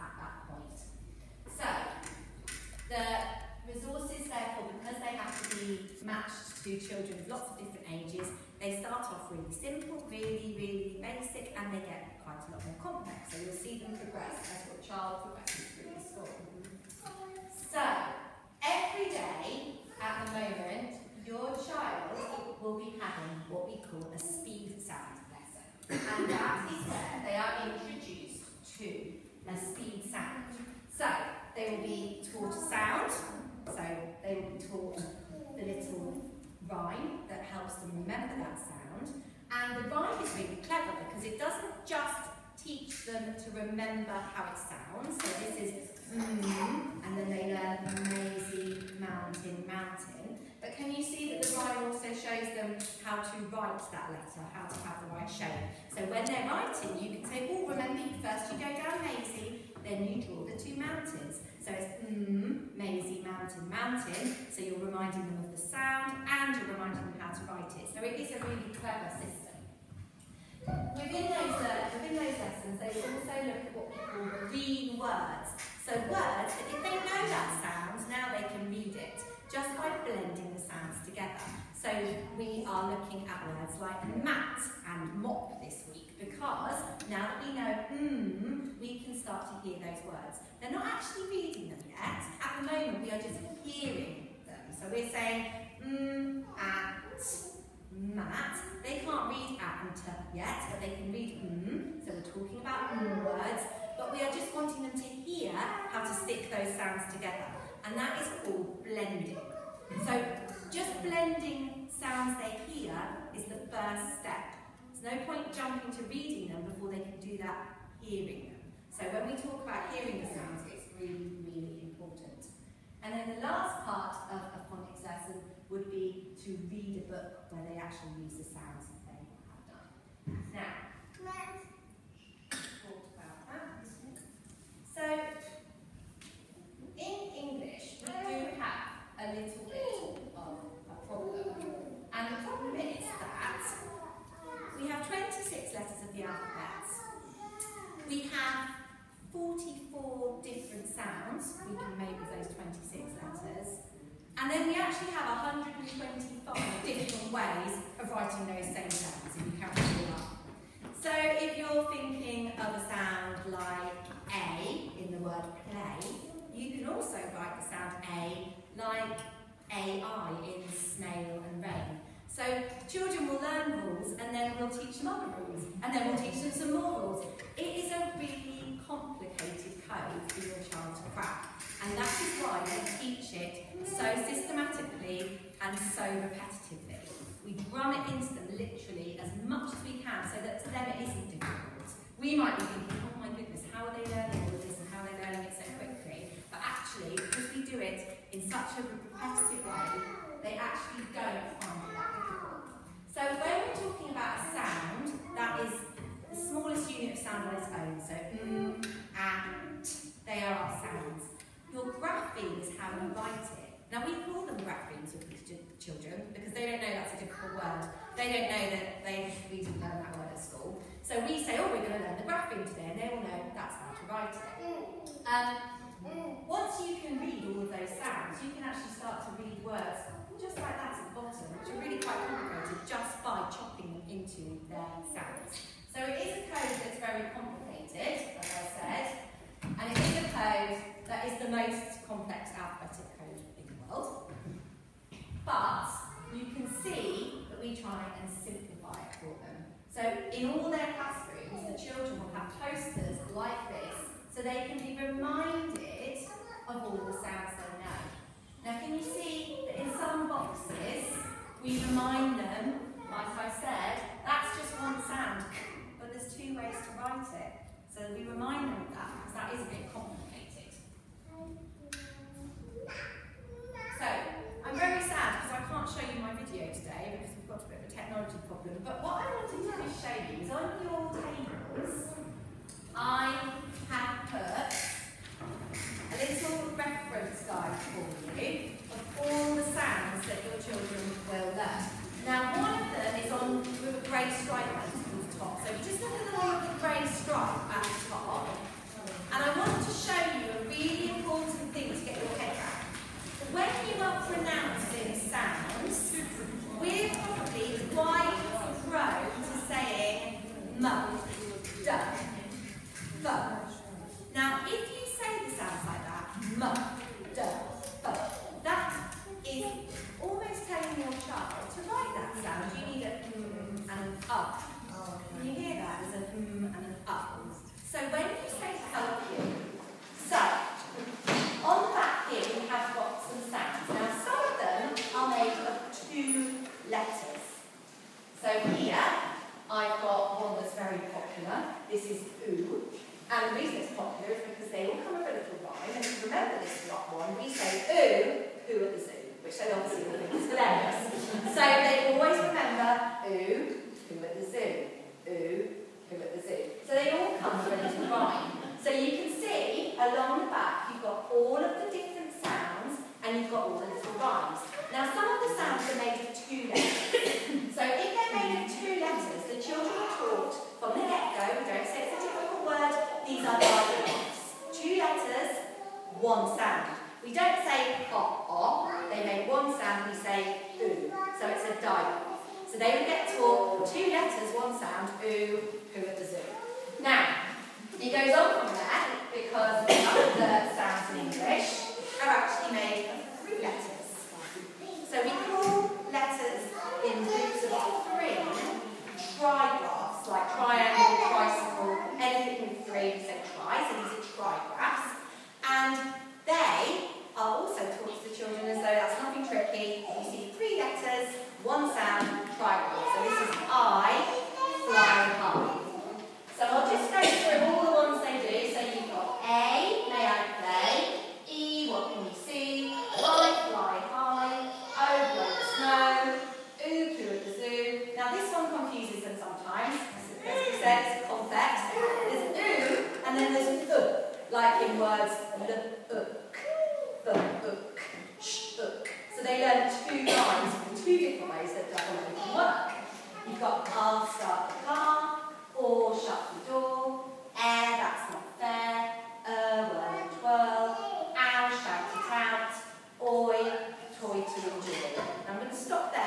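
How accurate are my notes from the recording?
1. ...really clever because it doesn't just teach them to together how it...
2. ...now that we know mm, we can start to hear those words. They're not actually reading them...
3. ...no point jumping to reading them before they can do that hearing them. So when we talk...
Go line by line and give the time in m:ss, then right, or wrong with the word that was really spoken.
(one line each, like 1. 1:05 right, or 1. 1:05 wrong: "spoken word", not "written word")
1. 0:40 wrong: "remember", not "together"
2. 1:27 right
3. 1:55 right.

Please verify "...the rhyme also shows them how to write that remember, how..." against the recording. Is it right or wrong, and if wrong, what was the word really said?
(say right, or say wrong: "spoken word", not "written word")
wrong: "letter", not "remember".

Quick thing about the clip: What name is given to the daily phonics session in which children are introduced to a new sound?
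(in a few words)
speed sound lesson.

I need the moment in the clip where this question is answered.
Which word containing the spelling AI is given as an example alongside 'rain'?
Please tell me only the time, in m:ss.
2:50.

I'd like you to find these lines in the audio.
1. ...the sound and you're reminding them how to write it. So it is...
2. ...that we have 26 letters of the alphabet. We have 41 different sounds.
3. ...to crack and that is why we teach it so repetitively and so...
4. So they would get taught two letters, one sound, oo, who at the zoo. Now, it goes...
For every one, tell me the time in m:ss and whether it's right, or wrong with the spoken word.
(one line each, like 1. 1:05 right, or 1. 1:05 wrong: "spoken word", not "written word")
1. 1:05 right
2. 2:23 wrong: "44", not "41"
3. 3:00 wrong: "systematically", not "repetitively"
4. 6:22 right.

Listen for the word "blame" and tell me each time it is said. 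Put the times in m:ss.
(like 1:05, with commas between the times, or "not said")
not said.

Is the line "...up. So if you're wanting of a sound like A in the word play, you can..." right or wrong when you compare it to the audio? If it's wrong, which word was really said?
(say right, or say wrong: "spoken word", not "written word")
wrong: "thinking", not "wanting".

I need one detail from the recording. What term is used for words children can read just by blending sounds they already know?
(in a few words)
green words.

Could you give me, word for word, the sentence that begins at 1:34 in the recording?
So we're saying mm, at, mat.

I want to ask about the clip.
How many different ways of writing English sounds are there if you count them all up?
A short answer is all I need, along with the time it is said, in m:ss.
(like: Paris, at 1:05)
125, at 2:35.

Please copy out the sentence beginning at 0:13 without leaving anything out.
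So you'll see them progress as child school.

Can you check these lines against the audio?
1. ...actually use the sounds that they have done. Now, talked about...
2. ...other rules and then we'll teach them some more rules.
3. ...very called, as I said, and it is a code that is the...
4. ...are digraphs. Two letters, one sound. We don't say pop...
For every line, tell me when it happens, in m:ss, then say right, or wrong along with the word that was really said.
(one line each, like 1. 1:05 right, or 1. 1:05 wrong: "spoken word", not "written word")
1. 2:07 right
2. 2:55 right
3. 3:56 wrong: "complicated", not "called"
4. 6:13 right.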